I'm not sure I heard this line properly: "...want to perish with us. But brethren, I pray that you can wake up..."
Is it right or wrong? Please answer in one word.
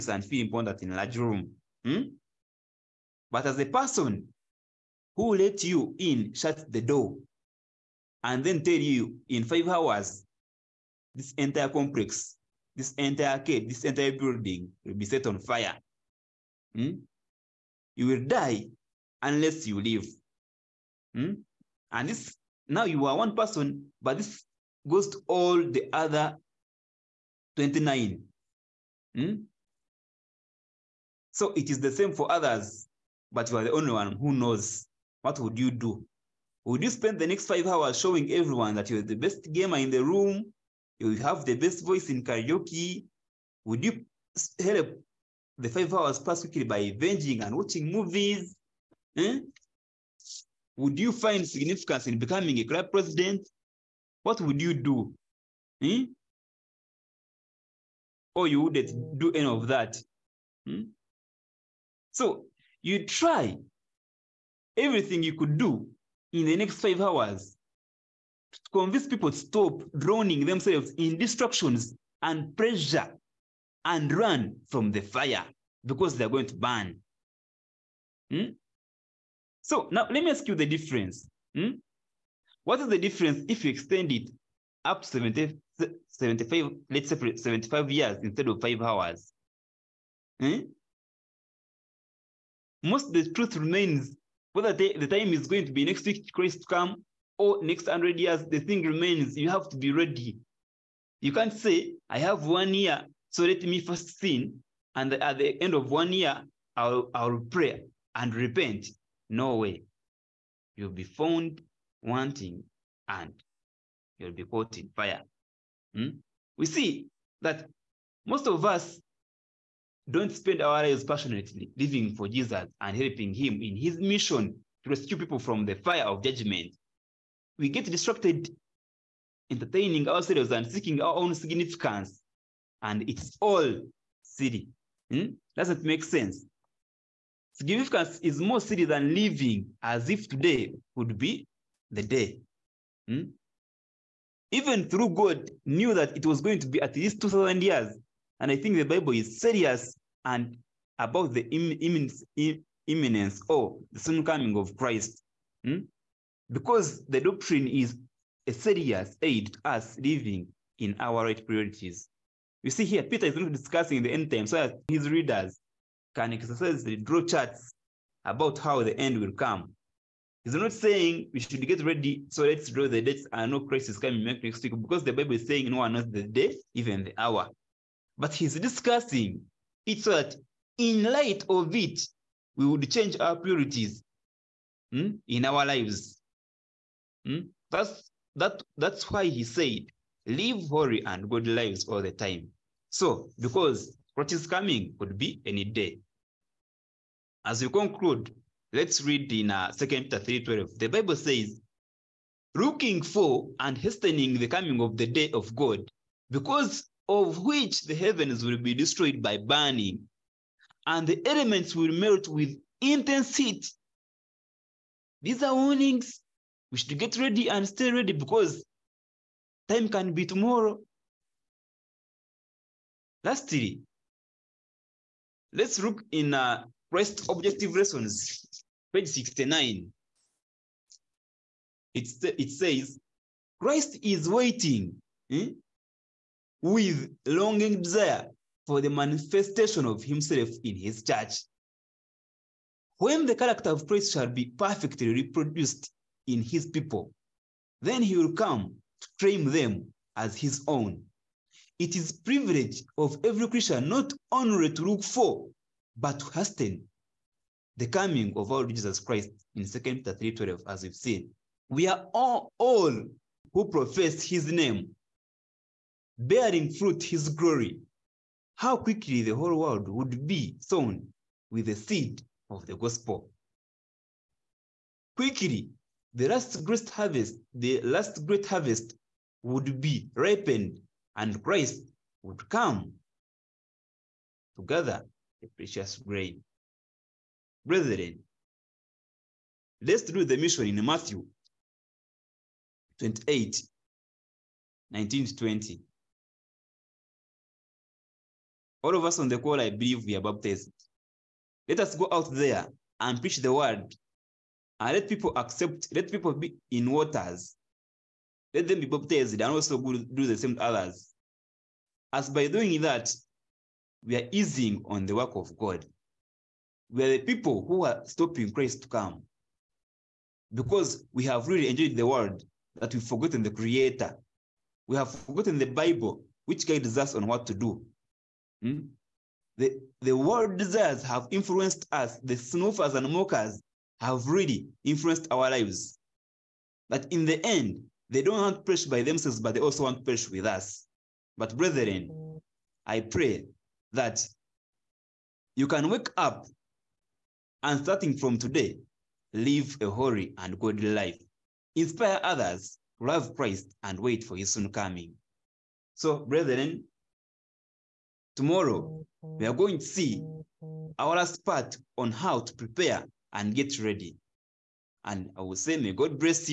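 right.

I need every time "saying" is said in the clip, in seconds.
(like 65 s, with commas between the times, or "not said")
170 s, 175 s.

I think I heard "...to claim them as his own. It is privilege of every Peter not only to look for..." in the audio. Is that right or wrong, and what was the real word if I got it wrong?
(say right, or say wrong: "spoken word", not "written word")
wrong: "Christian", not "Peter".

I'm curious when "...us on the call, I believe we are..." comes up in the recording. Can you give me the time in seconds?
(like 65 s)
299 s.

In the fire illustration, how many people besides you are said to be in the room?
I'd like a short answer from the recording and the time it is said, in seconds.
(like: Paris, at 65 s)
29, at 27 s.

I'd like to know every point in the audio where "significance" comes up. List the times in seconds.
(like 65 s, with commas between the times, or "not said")
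51 s, 131 s, 137 s.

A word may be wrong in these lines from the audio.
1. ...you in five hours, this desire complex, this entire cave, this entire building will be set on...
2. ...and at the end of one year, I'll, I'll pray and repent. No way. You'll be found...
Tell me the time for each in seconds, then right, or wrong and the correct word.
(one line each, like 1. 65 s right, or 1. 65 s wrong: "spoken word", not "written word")
1. 8 s wrong: "entire", not "desire"
2. 104 s right.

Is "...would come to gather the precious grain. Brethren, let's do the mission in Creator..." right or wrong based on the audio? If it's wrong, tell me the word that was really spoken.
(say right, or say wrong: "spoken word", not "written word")
wrong: "Matthew", not "Creator".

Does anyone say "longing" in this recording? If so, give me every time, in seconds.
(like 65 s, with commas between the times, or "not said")
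237 s.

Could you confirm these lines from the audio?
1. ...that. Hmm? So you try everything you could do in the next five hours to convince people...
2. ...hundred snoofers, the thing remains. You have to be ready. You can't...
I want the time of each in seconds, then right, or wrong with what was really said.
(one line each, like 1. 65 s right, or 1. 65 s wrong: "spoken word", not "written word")
1. 59 s right
2. 97 s wrong: "years", not "snoofers".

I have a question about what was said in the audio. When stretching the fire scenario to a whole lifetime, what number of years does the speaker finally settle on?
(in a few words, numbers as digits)
75.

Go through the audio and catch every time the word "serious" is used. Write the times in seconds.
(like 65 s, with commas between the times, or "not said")
149 s, 158 s.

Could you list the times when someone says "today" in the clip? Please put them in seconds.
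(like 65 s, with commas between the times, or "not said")
140 s, 348 s.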